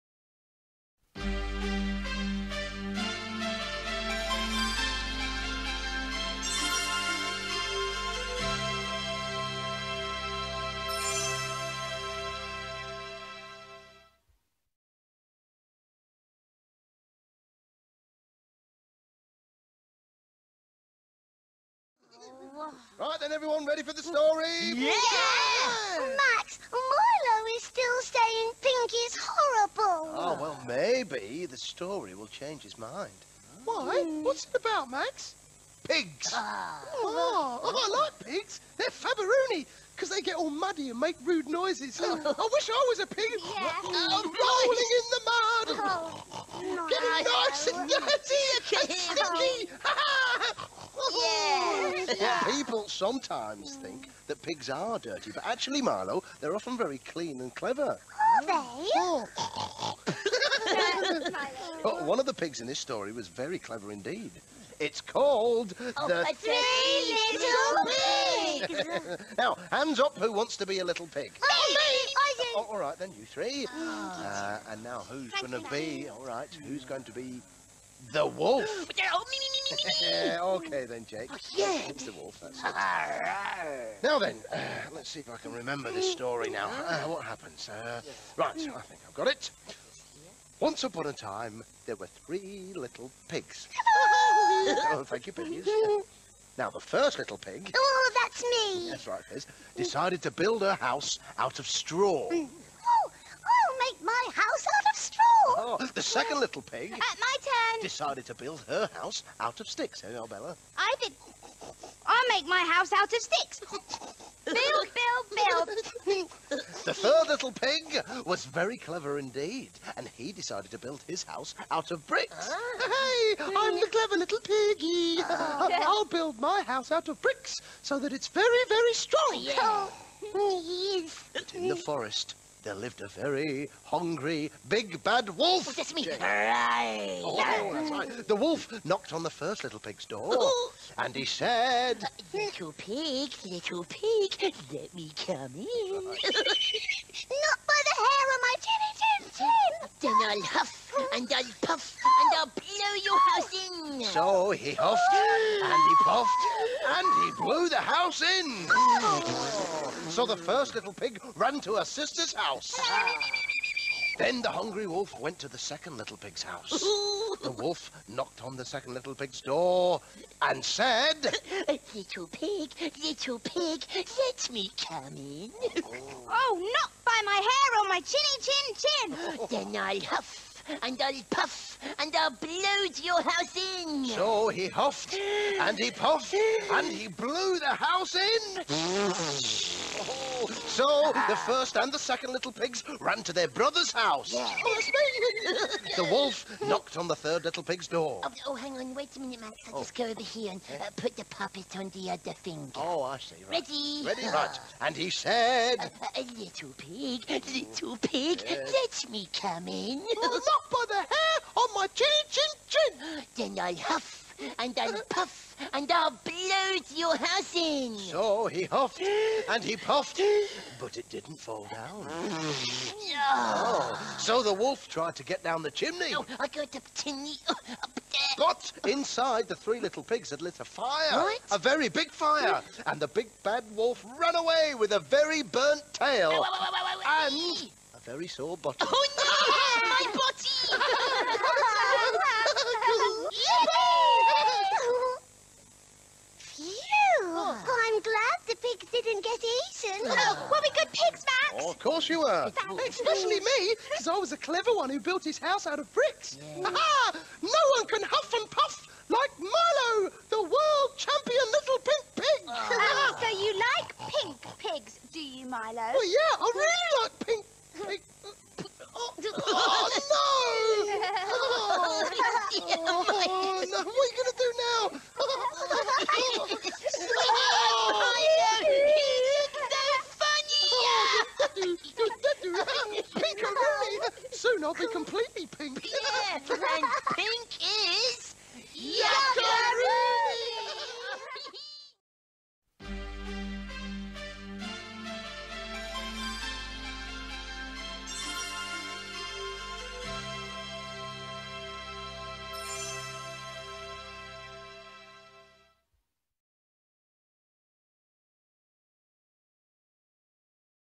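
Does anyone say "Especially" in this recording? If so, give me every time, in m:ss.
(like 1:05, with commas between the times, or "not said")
4:12.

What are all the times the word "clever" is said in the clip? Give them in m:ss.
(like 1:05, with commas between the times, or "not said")
0:57, 1:03, 1:58, 2:03, 4:14.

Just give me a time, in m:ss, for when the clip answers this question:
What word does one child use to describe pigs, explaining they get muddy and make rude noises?
0:38.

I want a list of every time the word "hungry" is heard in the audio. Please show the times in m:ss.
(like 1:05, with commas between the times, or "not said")
2:13, 2:44.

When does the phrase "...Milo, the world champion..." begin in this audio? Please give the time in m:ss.
4:19.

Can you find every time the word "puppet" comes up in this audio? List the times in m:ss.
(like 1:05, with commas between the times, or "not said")
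3:21.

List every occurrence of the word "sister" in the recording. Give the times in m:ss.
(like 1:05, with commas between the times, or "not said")
2:41.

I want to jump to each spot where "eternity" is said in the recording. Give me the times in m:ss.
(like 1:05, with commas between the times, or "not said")
not said.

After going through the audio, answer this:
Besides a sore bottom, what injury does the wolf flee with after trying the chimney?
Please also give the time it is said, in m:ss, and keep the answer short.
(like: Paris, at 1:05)
a very burnt tail, at 3:54.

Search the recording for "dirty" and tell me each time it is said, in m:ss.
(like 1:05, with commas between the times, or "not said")
0:47, 0:54.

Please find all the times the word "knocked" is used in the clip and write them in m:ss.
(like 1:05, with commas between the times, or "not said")
2:18, 2:48, 3:16.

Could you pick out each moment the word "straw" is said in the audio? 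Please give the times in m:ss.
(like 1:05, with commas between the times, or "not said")
1:41.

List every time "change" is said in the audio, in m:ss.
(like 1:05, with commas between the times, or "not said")
0:32.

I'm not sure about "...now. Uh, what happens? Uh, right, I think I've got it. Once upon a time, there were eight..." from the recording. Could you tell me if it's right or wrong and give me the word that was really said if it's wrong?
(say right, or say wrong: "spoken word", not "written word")
wrong: "three", not "eight".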